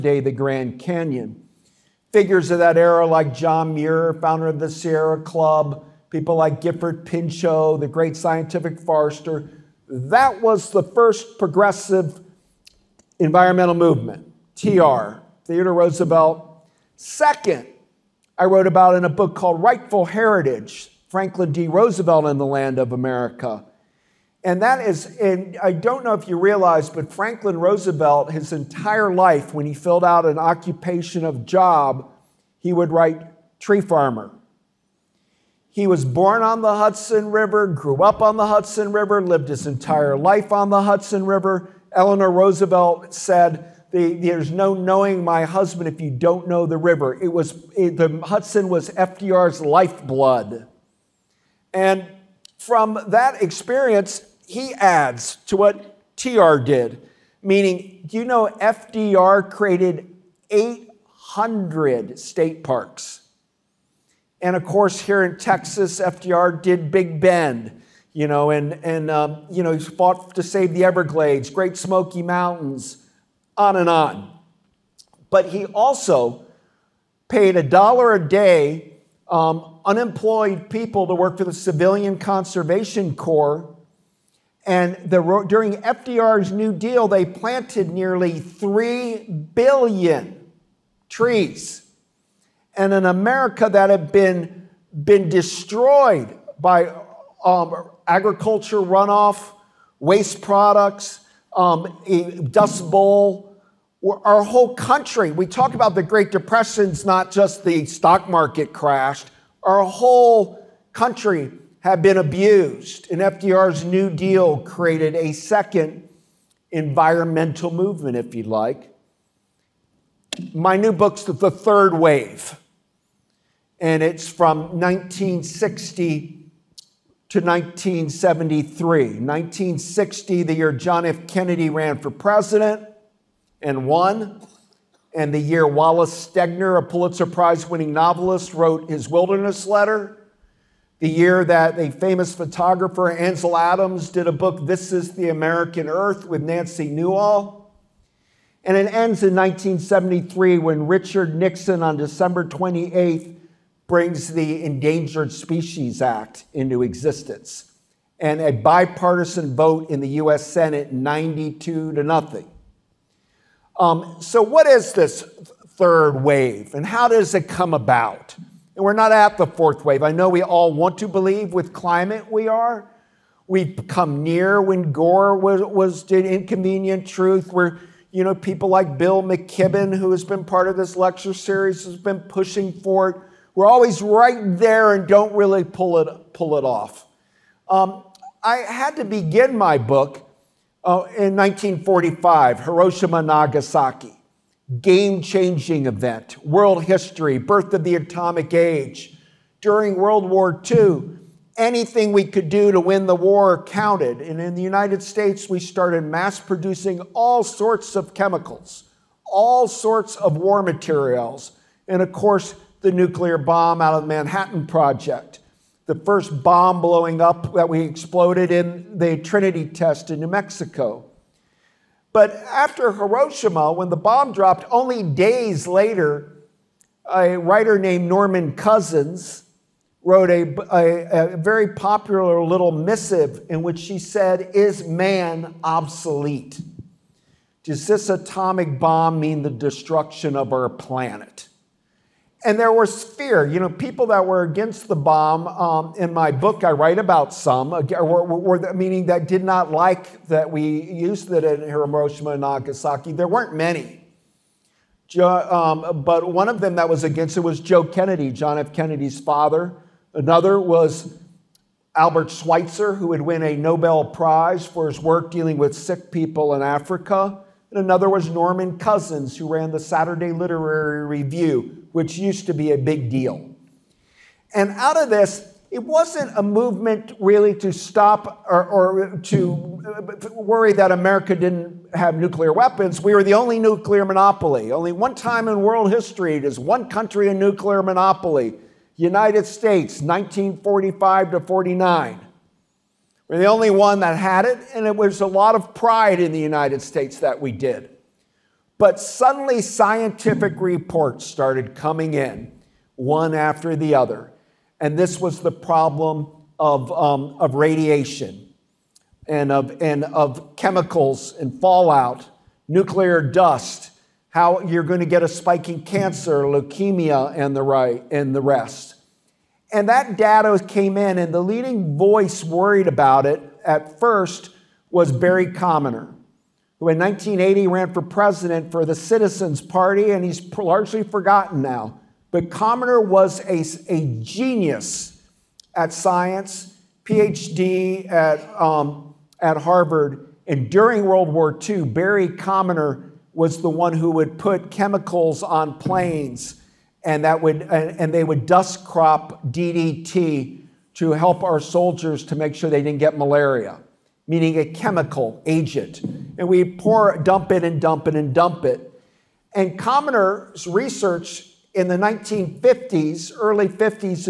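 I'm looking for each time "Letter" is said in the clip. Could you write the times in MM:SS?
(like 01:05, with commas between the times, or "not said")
02:19.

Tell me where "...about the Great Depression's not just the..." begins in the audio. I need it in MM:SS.
01:45.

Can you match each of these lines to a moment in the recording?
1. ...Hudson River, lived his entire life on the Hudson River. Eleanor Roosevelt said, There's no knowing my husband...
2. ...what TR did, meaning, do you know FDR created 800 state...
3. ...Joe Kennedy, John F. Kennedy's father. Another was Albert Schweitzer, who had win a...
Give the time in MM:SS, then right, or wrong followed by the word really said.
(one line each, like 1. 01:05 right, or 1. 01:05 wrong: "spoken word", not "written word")
1. 00:38 right
2. 00:55 right
3. 04:17 right.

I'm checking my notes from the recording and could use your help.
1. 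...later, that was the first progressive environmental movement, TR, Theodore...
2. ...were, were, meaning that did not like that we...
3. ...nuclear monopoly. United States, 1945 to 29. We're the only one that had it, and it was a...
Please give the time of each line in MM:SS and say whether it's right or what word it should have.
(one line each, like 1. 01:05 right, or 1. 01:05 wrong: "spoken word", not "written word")
1. 00:08 wrong: "forester", not "later"
2. 04:07 right
3. 04:47 wrong: "49", not "29".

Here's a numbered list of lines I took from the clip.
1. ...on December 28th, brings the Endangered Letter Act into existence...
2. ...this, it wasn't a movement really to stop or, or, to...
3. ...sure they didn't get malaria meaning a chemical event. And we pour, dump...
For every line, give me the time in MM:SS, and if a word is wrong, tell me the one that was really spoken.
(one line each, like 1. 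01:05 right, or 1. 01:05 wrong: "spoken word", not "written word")
1. 02:31 wrong: "Species", not "Letter"
2. 04:35 right
3. 05:52 wrong: "agent", not "event".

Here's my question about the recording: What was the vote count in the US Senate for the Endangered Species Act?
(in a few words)
92 to 0.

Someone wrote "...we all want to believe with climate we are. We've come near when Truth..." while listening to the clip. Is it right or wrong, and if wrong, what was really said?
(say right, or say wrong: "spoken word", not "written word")
wrong: "Gore", not "Truth".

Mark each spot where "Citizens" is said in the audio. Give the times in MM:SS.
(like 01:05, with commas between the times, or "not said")
05:28.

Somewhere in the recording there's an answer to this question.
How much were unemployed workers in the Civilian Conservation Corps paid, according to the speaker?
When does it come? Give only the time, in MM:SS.
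01:17.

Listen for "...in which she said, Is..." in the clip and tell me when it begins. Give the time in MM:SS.
03:53.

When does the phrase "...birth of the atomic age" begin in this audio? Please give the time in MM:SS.
03:17.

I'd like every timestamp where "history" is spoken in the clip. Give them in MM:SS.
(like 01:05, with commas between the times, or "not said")
03:16, 04:45.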